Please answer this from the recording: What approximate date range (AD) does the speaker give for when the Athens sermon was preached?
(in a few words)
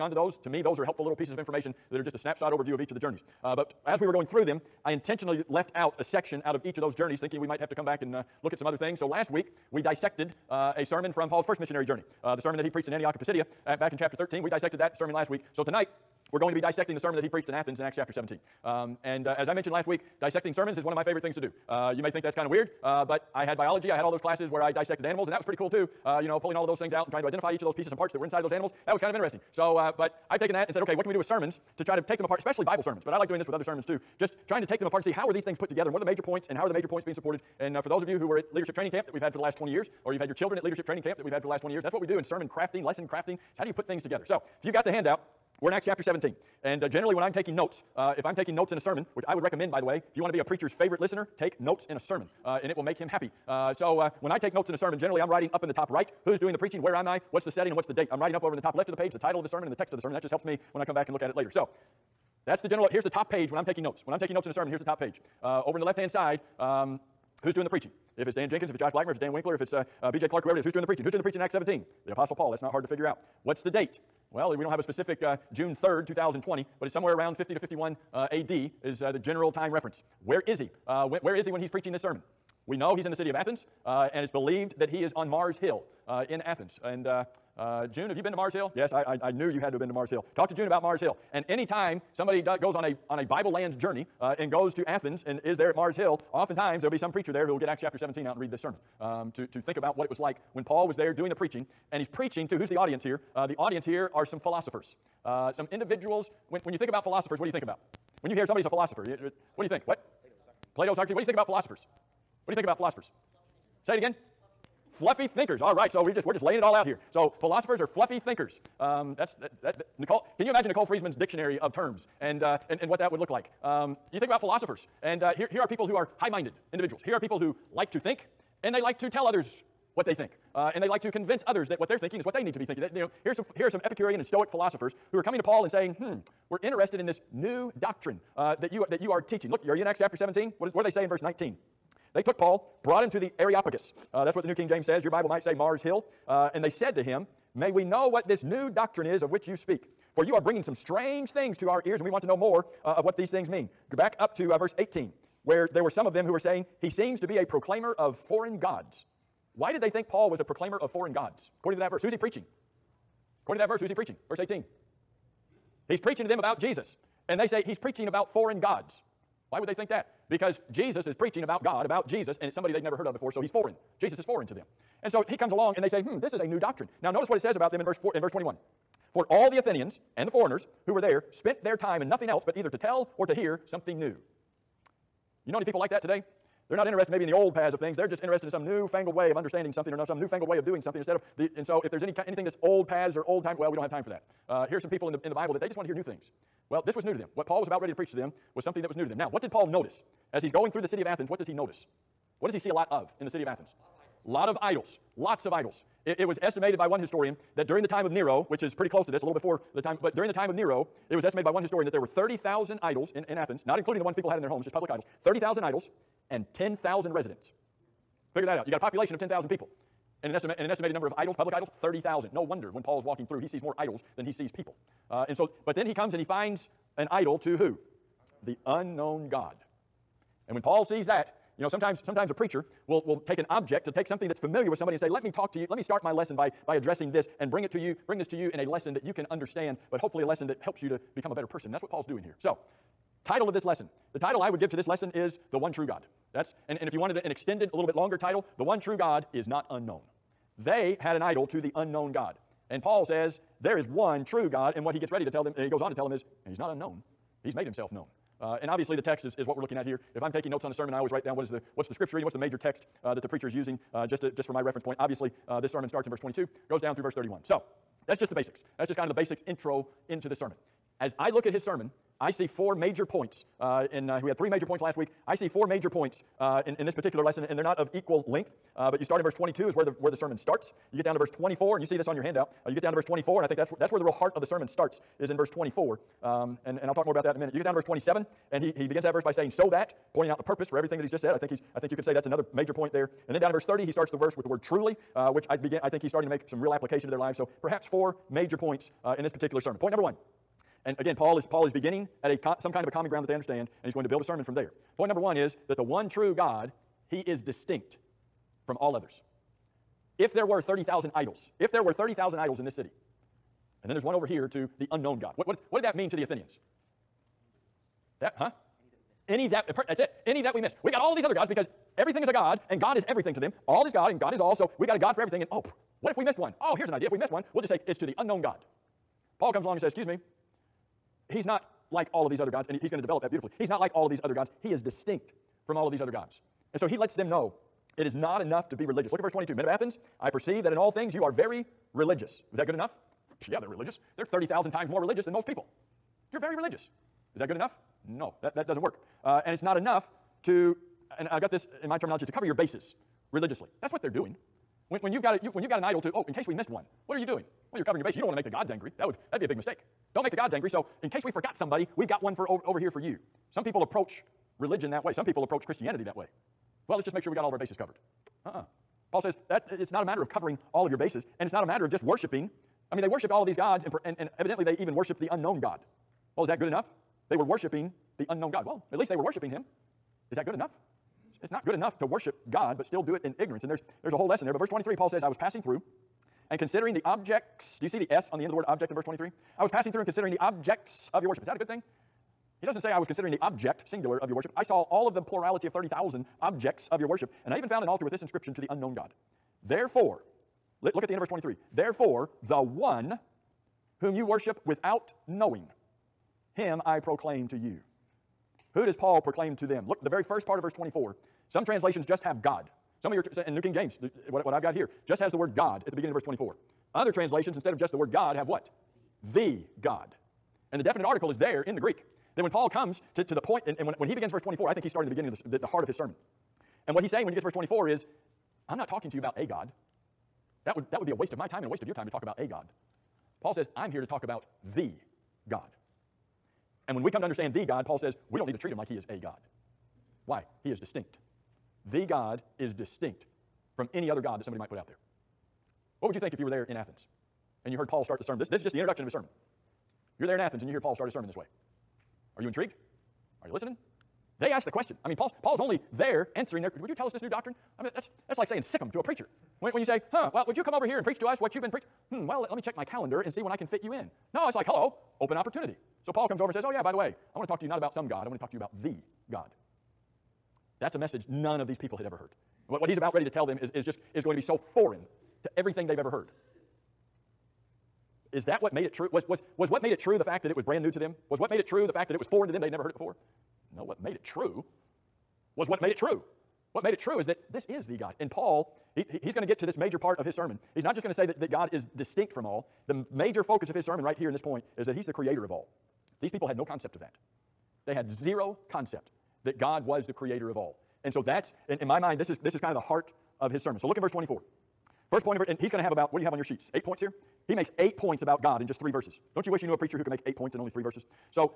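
50 to 51 AD.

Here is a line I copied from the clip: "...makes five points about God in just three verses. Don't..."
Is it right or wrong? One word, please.
wrong.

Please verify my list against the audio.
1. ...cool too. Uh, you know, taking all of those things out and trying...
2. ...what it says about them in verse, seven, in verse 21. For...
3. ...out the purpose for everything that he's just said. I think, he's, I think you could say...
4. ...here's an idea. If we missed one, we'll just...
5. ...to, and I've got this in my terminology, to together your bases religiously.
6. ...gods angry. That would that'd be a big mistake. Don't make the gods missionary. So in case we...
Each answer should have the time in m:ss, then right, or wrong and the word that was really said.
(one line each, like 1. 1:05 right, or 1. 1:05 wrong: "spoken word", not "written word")
1. 0:25 wrong: "pulling", not "taking"
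2. 2:57 wrong: "four", not "seven"
3. 4:50 right
4. 5:26 right
5. 5:50 wrong: "cover", not "together"
6. 5:58 wrong: "angry", not "missionary".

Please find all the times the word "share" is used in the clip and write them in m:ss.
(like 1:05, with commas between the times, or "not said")
not said.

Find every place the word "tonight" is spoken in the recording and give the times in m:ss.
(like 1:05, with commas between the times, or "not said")
0:15.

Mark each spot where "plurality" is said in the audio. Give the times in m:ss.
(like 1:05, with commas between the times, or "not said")
6:35.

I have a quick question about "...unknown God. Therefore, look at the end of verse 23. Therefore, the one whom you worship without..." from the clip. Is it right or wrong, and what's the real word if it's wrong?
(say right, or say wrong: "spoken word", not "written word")
right.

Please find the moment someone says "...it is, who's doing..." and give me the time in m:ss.
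1:10.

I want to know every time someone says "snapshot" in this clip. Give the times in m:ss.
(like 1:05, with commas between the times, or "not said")
0:02.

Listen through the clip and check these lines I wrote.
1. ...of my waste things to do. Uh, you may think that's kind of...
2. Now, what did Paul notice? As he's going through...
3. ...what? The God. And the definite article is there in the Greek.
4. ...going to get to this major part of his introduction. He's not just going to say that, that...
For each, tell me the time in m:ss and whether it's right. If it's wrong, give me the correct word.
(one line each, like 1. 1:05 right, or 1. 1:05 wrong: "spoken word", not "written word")
1. 0:20 wrong: "favorite", not "waste"
2. 3:19 right
3. 6:58 right
4. 8:09 wrong: "sermon", not "introduction".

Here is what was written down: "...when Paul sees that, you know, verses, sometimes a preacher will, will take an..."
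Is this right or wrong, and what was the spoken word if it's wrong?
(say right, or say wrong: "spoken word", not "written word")
wrong: "sometimes", not "verses".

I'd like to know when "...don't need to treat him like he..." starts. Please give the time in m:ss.
7:18.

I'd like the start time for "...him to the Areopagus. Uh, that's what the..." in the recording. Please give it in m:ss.
2:23.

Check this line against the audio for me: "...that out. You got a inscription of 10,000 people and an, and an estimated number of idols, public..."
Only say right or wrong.
wrong.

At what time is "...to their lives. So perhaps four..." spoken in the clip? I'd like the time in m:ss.
4:57.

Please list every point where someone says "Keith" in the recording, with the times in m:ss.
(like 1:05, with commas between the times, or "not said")
not said.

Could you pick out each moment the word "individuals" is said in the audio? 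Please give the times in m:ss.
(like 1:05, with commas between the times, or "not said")
1:45, 2:06.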